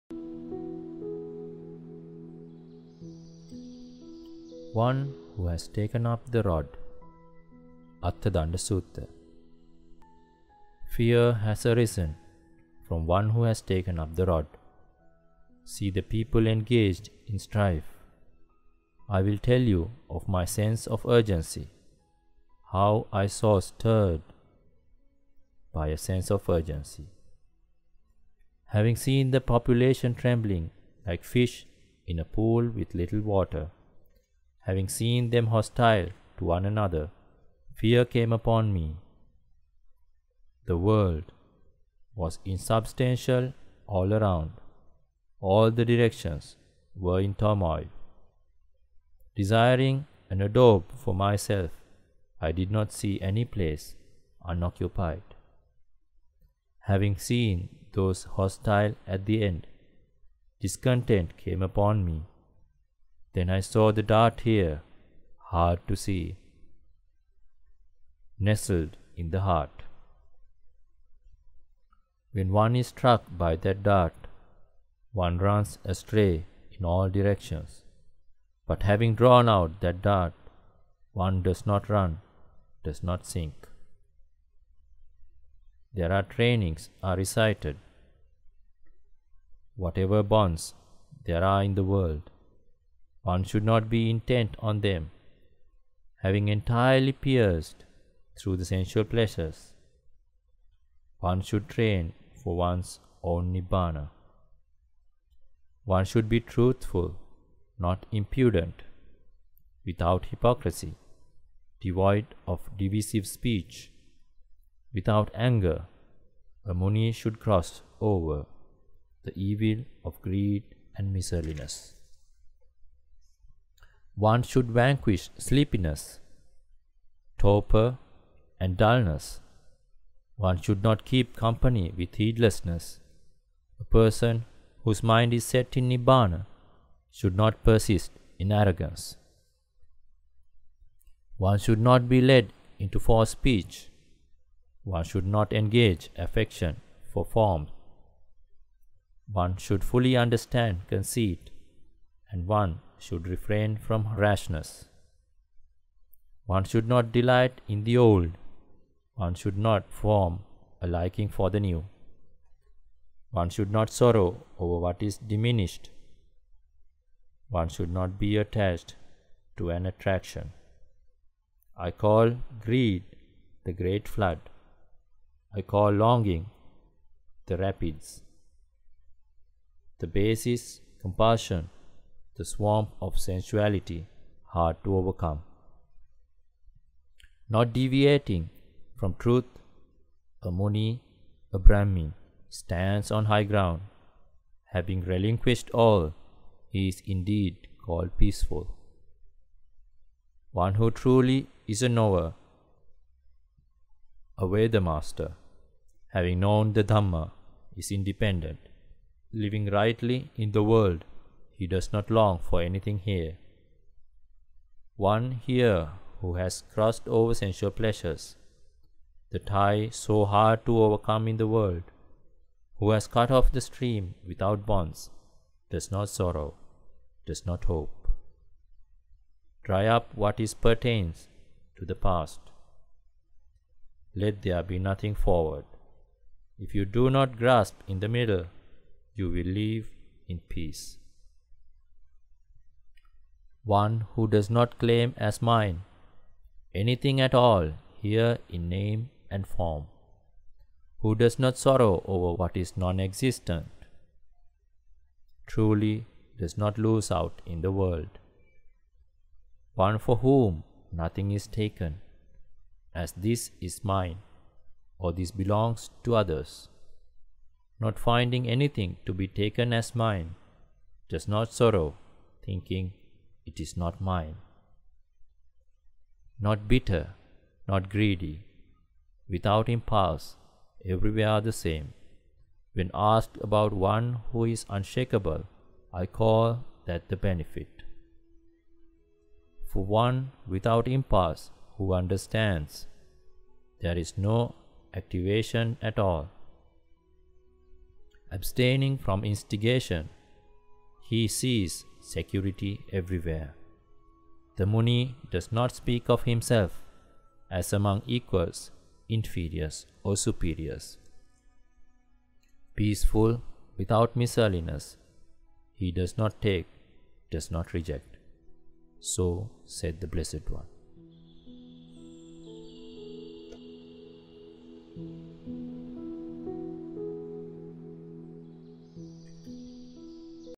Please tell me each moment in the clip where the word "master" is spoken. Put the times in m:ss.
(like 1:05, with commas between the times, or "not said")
3:24.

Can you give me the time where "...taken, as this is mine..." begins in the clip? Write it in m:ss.
4:21.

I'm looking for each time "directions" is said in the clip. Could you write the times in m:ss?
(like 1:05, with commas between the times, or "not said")
0:45, 1:17.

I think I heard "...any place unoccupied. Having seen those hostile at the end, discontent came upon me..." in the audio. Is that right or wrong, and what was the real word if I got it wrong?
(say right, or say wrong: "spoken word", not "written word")
right.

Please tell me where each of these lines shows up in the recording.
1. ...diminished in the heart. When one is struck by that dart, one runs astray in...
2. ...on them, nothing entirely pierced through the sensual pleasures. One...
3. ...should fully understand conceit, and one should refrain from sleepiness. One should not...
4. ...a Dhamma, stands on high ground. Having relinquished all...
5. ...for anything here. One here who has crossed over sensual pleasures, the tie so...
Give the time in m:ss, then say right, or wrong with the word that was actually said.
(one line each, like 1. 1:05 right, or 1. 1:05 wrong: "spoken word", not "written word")
1. 1:08 wrong: "nestled", not "diminished"
2. 1:34 wrong: "having", not "nothing"
3. 2:29 wrong: "rashness", not "sleepiness"
4. 3:11 wrong: "Brahmin", not "Dhamma"
5. 3:32 right.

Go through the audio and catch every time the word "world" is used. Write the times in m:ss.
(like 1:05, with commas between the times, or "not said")
0:40, 1:31, 3:30, 3:41, 4:17.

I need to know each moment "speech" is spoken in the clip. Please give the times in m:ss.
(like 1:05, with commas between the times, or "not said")
1:53, 2:23.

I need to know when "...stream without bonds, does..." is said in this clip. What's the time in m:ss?
3:43.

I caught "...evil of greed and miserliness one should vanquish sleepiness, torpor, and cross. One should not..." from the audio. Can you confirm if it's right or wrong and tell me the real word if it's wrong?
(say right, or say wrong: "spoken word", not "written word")
wrong: "dullness", not "cross".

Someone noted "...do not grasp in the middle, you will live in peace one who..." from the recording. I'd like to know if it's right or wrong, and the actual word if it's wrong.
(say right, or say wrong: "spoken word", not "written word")
right.